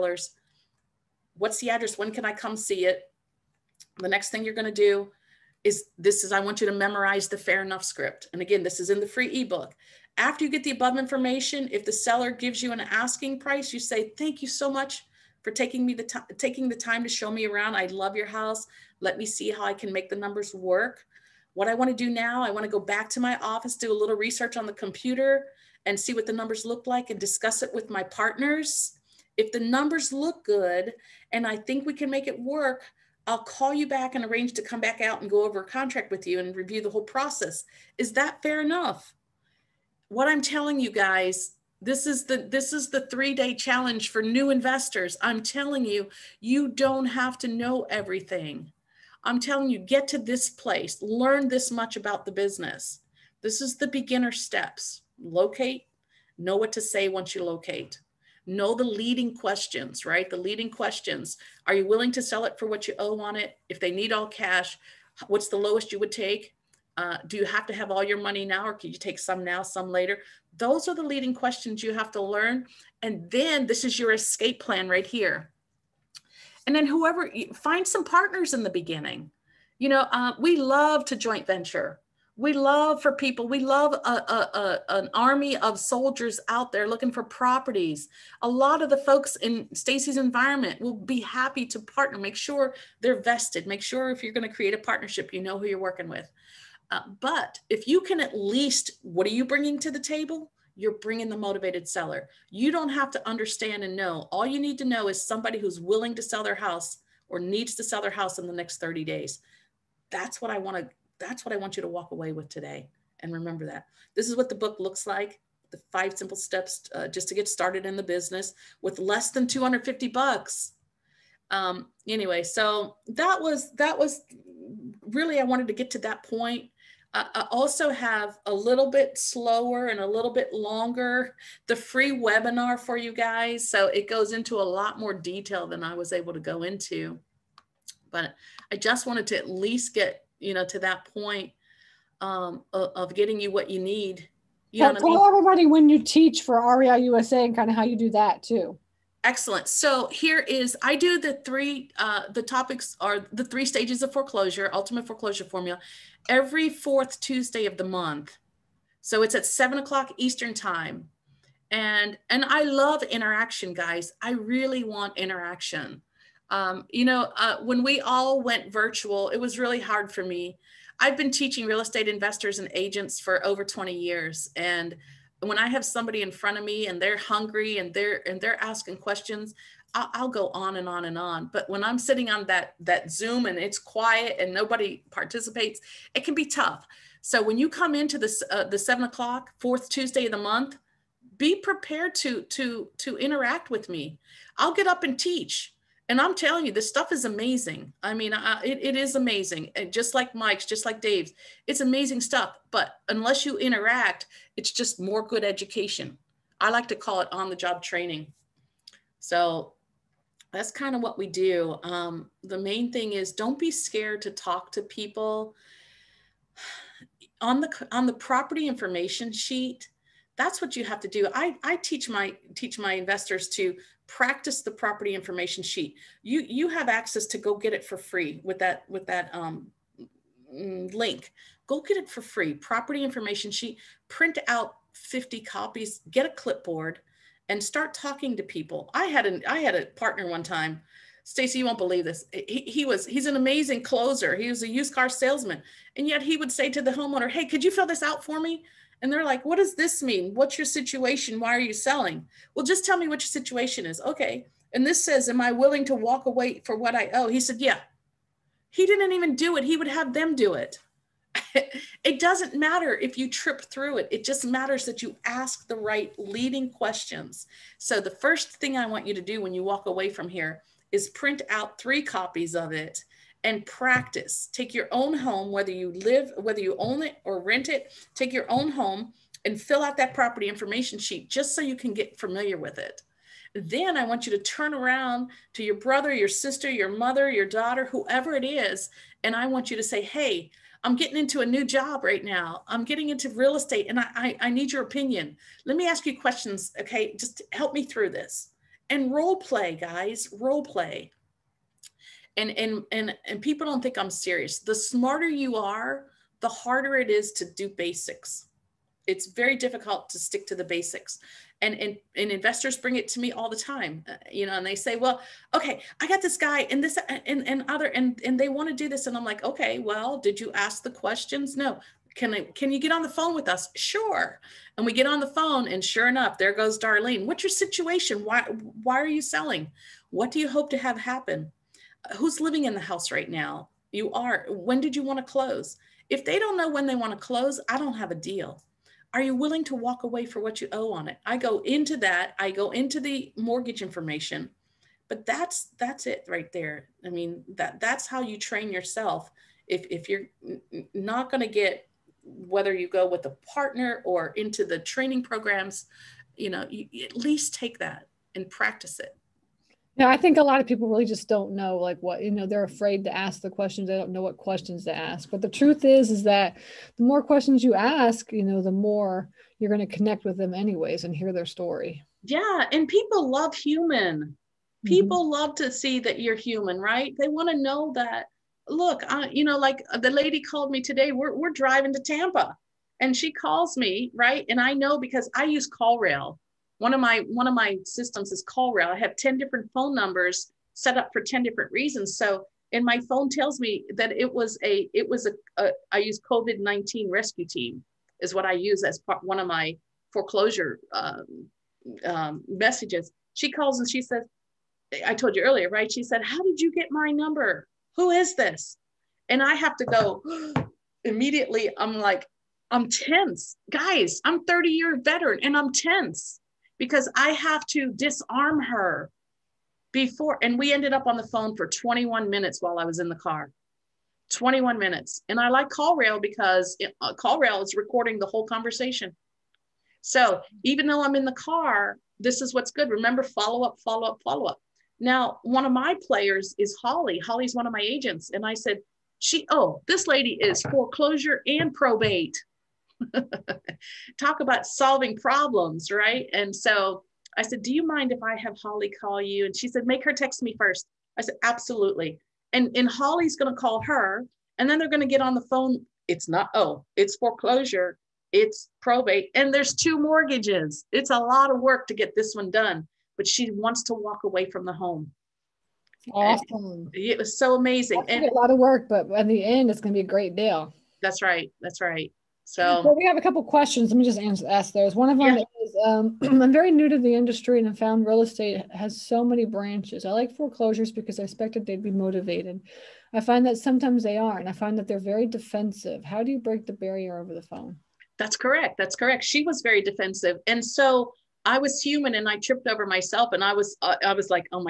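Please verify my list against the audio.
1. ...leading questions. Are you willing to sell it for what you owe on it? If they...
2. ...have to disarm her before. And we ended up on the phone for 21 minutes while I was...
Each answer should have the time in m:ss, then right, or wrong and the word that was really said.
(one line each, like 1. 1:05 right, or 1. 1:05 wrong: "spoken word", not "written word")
1. 1:00 right
2. 6:57 right.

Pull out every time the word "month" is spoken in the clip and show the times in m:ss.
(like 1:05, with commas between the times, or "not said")
2:37, 3:10.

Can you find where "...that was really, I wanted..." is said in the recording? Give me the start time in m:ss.
2:03.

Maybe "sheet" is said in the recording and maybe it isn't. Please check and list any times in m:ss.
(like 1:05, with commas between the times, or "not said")
3:39, 3:45, 3:53, 4:40.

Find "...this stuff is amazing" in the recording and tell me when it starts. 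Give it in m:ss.
3:16.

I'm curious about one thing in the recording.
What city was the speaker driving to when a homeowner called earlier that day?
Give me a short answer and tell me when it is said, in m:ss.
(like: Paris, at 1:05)
Tampa, at 6:22.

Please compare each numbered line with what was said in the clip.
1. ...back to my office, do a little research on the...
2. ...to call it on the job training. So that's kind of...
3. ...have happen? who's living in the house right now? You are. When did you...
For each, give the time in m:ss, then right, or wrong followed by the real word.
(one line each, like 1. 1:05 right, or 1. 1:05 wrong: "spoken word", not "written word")
1. 0:22 right
2. 3:26 right
3. 5:30 right.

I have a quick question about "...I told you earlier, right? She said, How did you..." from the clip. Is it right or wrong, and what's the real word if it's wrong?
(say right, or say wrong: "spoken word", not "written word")
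right.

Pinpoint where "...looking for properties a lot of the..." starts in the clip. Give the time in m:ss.
1:26.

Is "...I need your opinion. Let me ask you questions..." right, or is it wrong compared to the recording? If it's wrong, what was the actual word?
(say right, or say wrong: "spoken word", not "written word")
right.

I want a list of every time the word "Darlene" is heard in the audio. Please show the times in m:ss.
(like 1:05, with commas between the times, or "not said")
5:26.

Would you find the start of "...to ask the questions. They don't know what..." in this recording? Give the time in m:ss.
6:03.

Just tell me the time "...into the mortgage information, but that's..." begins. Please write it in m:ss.
5:42.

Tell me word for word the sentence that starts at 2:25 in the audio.
everybody when you teach for REI USA and kind of how you do that too.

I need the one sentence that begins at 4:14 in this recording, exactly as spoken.
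And this says, am I willing to walk away for what I owe?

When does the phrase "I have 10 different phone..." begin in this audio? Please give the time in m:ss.
6:28.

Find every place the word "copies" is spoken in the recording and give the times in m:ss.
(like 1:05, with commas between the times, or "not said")
3:55, 4:32.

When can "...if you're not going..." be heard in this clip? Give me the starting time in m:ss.
5:49.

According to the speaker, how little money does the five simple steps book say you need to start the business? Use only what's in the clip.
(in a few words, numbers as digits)
$250.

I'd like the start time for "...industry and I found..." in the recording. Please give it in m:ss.
7:57.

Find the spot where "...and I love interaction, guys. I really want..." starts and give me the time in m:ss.
2:42.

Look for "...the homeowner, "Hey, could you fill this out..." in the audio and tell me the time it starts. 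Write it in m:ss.
4:06.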